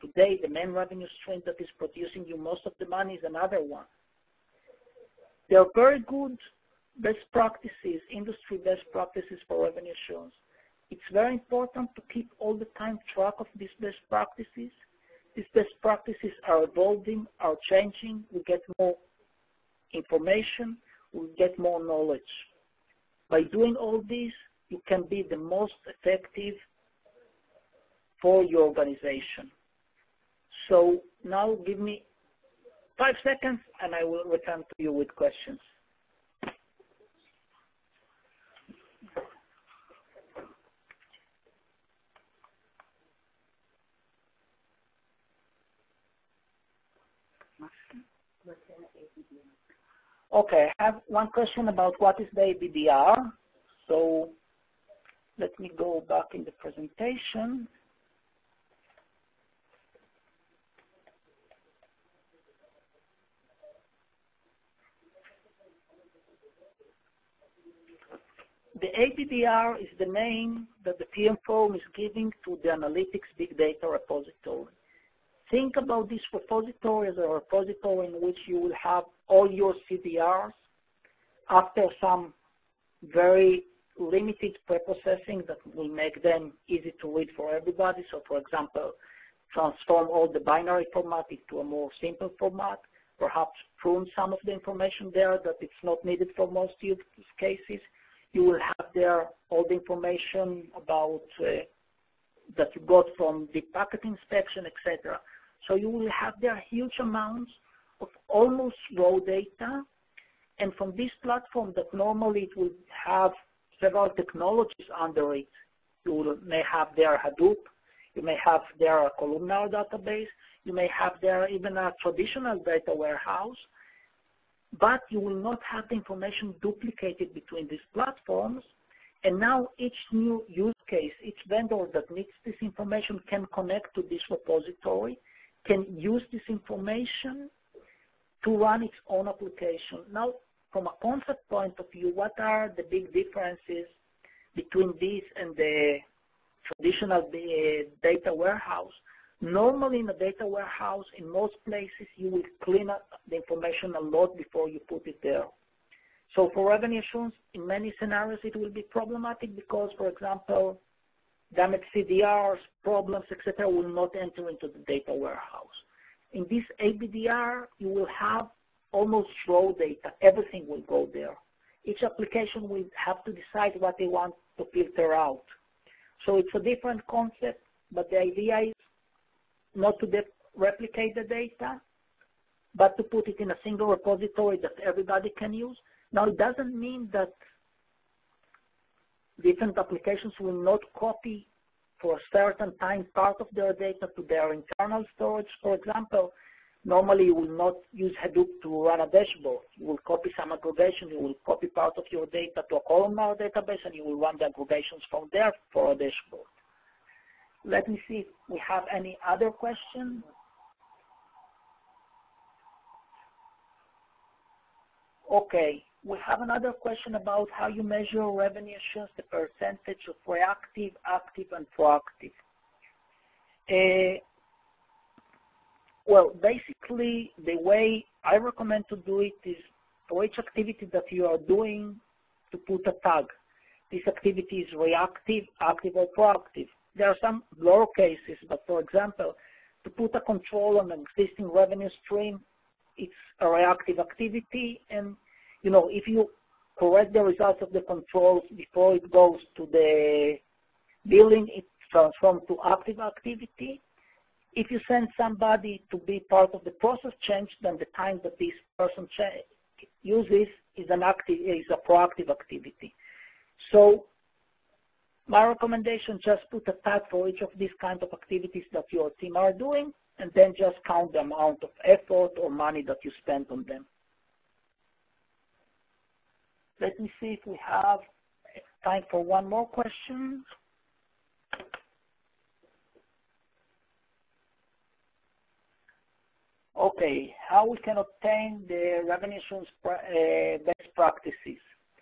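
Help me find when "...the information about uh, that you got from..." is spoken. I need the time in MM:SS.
01:39.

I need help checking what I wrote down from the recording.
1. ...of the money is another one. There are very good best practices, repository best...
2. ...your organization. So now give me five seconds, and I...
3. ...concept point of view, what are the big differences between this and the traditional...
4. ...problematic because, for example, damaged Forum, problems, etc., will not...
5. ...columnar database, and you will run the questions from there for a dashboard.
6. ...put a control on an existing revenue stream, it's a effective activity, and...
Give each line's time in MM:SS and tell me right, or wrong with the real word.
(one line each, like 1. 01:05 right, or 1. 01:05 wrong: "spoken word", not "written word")
1. 00:02 wrong: "industry", not "repository"
2. 00:28 right
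3. 02:21 right
4. 02:38 wrong: "CDRs", not "Forum"
5. 03:22 wrong: "aggregations", not "questions"
6. 03:59 wrong: "reactive", not "effective".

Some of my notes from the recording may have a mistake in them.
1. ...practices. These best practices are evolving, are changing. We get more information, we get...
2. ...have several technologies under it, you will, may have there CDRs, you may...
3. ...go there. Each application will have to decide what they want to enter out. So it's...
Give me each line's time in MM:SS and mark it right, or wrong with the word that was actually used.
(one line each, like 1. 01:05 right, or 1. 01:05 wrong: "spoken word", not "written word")
1. 00:14 right
2. 01:52 wrong: "Hadoop", not "CDRs"
3. 02:50 wrong: "filter", not "enter".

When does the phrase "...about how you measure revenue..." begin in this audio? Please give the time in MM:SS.
03:37.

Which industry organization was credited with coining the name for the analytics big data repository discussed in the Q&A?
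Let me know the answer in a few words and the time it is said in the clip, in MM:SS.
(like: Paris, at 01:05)
TM Forum, at 01:11.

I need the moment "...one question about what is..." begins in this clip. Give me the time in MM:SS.
00:51.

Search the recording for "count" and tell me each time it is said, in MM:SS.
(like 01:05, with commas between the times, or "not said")
04:30.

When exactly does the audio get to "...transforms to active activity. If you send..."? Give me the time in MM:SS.
04:11.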